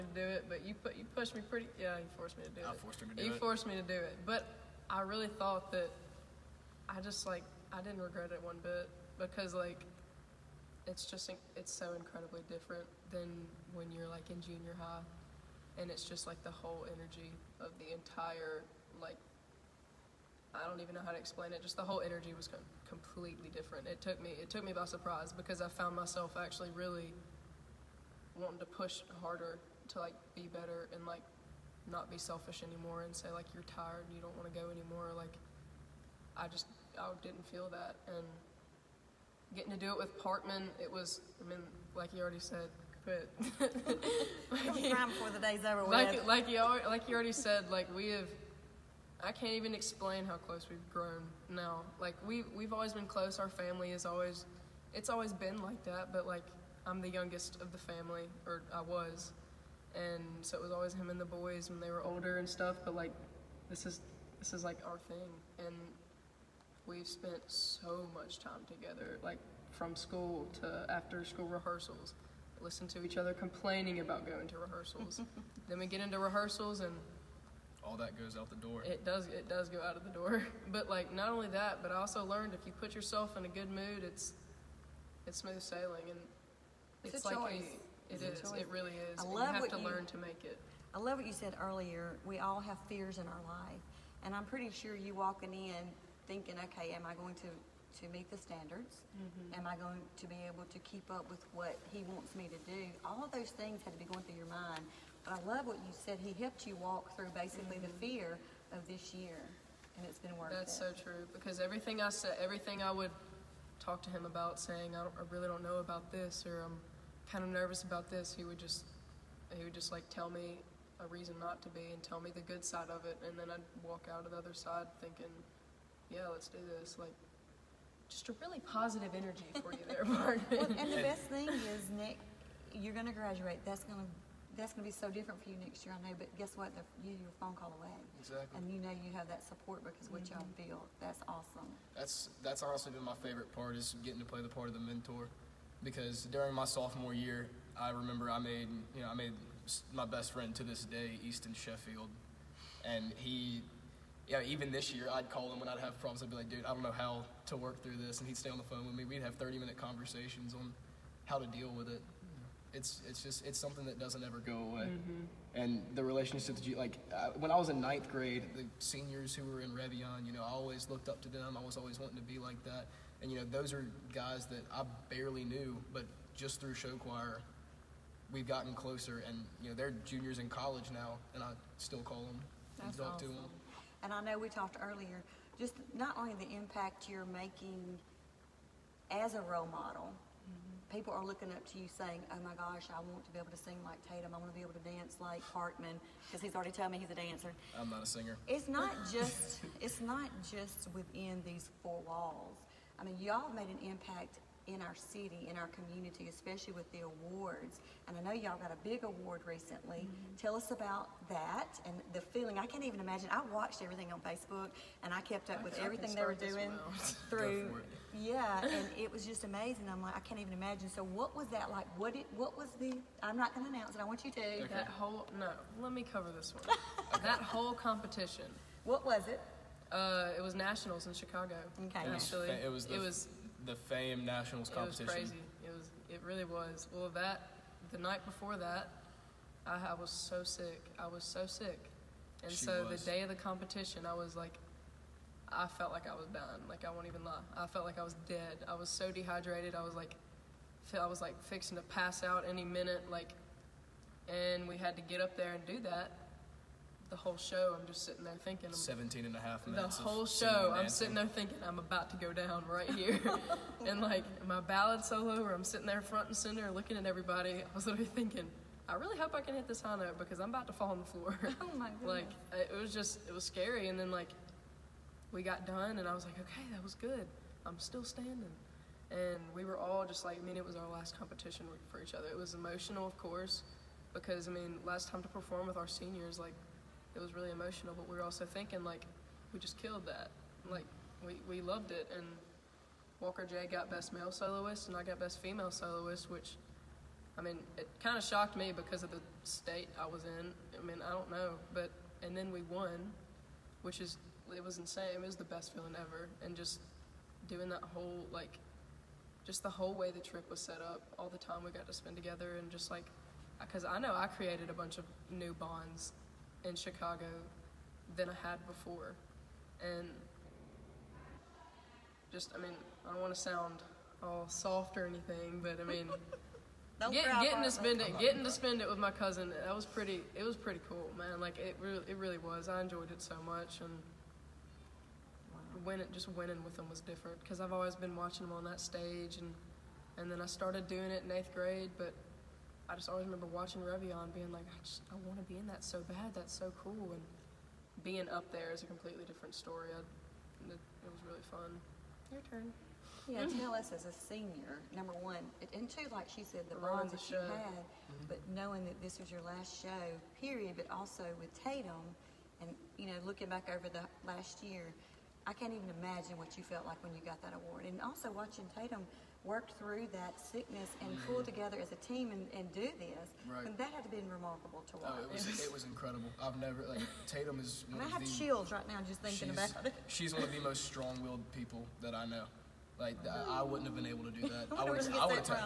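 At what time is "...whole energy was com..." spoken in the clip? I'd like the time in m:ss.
0:21.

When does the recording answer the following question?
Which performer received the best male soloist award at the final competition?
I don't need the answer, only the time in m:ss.
4:53.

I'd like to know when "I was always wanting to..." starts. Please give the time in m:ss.
2:51.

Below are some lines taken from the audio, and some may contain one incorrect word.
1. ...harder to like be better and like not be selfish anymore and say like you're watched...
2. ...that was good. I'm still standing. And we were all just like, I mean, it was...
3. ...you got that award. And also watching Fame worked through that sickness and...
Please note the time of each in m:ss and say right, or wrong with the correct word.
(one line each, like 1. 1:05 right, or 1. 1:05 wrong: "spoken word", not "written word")
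1. 0:29 wrong: "tired", not "watched"
2. 4:36 right
3. 6:07 wrong: "Tatum", not "Fame".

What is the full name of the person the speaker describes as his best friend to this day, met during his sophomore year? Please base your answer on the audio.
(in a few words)
Easton Sheffield.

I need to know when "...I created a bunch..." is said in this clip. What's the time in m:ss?
5:14.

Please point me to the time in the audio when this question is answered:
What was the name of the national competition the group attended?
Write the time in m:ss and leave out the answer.
3:53.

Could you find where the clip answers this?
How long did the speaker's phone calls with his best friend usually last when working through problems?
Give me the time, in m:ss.
2:39.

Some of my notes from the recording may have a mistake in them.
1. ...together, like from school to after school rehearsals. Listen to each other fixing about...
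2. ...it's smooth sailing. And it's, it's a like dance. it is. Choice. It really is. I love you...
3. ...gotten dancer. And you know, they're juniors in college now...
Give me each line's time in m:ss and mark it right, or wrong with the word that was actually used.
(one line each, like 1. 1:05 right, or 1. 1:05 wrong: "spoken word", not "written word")
1. 1:08 wrong: "complaining", not "fixing"
2. 1:25 wrong: "choice", not "dance"
3. 2:58 wrong: "closer", not "dancer".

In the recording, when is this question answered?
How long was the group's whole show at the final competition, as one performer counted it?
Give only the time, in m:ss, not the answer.
4:18.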